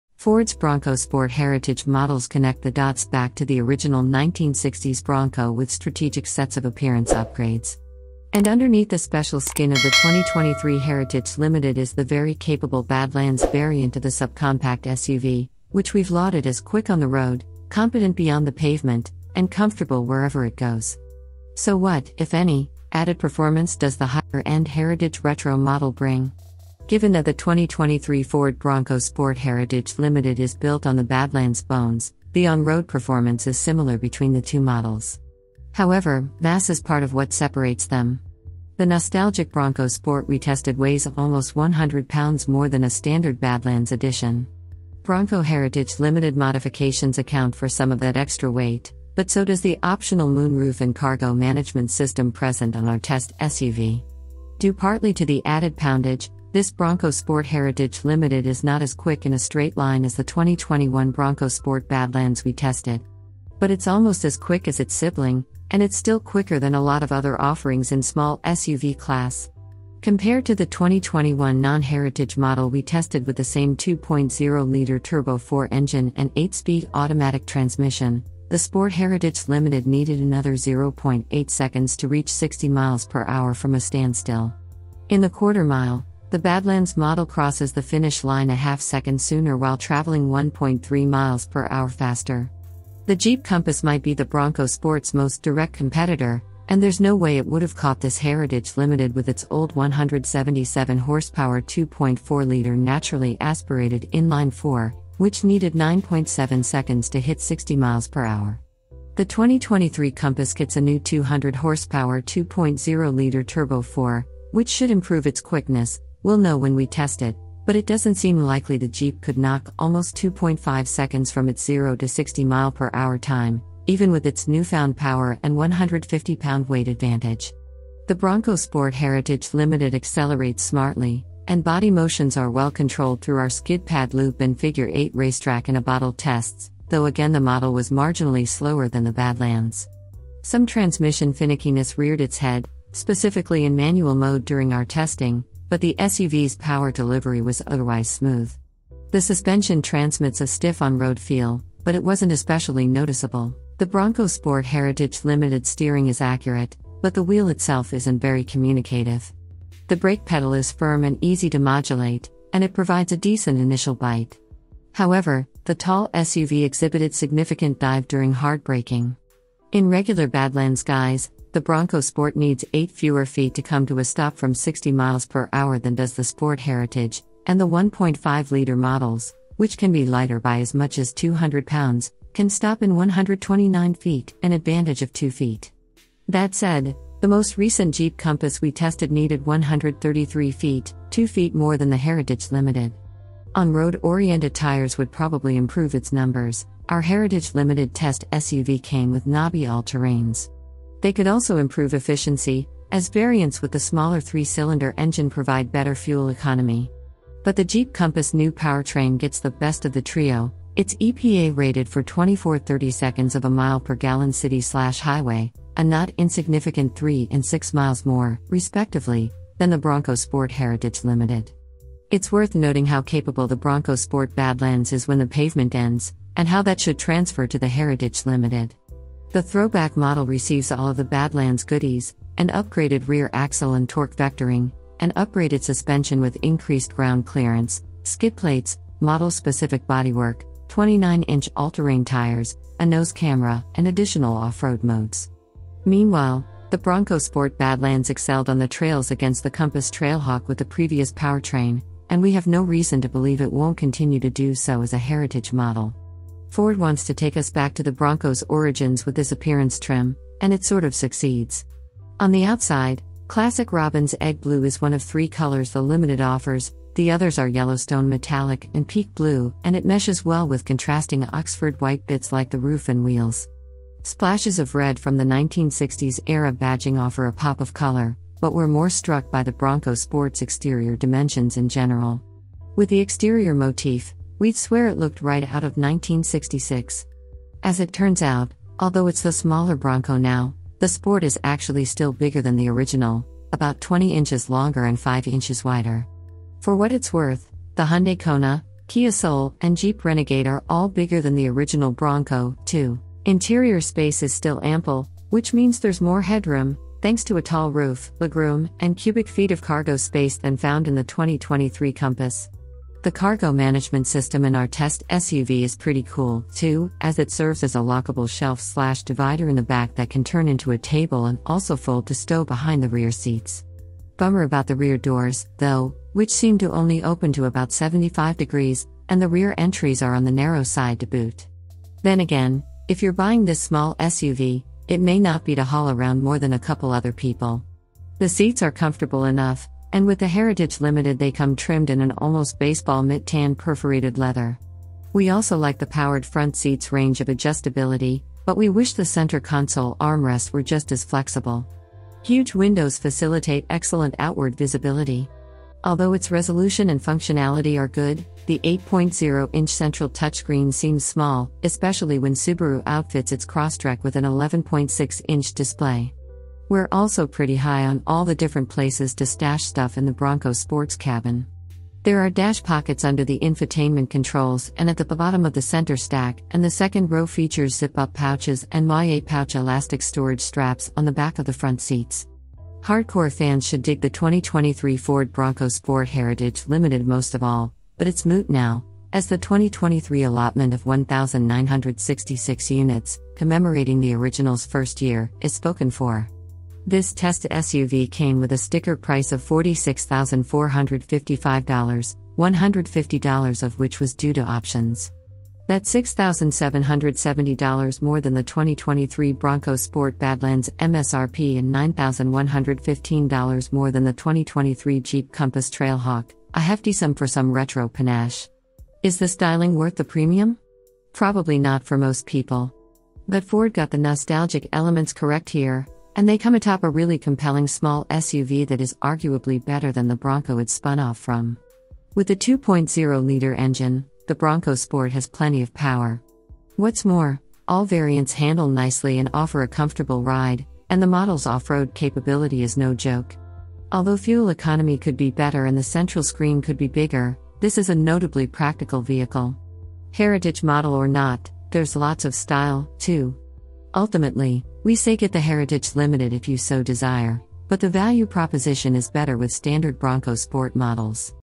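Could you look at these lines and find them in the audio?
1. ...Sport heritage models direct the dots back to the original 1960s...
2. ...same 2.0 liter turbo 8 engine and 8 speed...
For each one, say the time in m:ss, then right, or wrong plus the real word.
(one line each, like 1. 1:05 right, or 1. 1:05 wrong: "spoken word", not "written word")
1. 0:00 wrong: "connect", not "direct"
2. 1:13 wrong: "4", not "8".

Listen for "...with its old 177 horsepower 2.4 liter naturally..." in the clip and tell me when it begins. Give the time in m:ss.
1:39.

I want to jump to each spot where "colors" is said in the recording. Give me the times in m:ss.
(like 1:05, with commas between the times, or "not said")
4:25, 4:37.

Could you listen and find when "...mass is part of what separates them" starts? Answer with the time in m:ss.
0:36.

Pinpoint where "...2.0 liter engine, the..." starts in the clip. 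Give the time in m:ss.
7:12.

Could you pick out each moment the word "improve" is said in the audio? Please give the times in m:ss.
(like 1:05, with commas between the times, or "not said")
1:54, 3:15, 3:21.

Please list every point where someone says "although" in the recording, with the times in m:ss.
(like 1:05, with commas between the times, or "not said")
4:48, 5:55, 7:23.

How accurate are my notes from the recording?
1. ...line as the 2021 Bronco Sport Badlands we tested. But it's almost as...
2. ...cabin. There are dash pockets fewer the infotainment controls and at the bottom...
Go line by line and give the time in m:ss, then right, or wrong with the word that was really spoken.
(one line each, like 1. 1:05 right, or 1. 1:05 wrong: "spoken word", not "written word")
1. 0:59 right
2. 6:10 wrong: "under", not "fewer".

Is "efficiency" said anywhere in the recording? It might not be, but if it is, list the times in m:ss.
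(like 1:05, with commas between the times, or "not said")
3:21.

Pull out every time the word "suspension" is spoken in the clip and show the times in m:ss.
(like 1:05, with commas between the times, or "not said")
2:29, 3:55.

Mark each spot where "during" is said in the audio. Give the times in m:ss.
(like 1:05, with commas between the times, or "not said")
2:24, 2:48.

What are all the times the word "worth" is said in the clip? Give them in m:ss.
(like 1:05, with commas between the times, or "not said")
3:42, 4:57, 6:59.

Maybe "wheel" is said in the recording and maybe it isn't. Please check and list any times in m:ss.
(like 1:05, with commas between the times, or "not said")
2:37, 4:33.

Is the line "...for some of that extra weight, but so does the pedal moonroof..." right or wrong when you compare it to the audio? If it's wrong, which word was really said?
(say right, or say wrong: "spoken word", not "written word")
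wrong: "optional", not "pedal".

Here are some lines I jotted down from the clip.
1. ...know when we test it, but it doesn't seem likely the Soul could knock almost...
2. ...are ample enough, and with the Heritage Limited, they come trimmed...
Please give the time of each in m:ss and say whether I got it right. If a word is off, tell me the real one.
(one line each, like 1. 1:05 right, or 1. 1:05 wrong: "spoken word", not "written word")
1. 1:56 wrong: "Jeep", not "Soul"
2. 5:38 wrong: "comfortable", not "ample".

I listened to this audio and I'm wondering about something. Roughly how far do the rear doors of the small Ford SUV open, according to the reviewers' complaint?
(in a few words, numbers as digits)
75 degrees.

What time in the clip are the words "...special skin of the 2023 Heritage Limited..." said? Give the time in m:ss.
0:08.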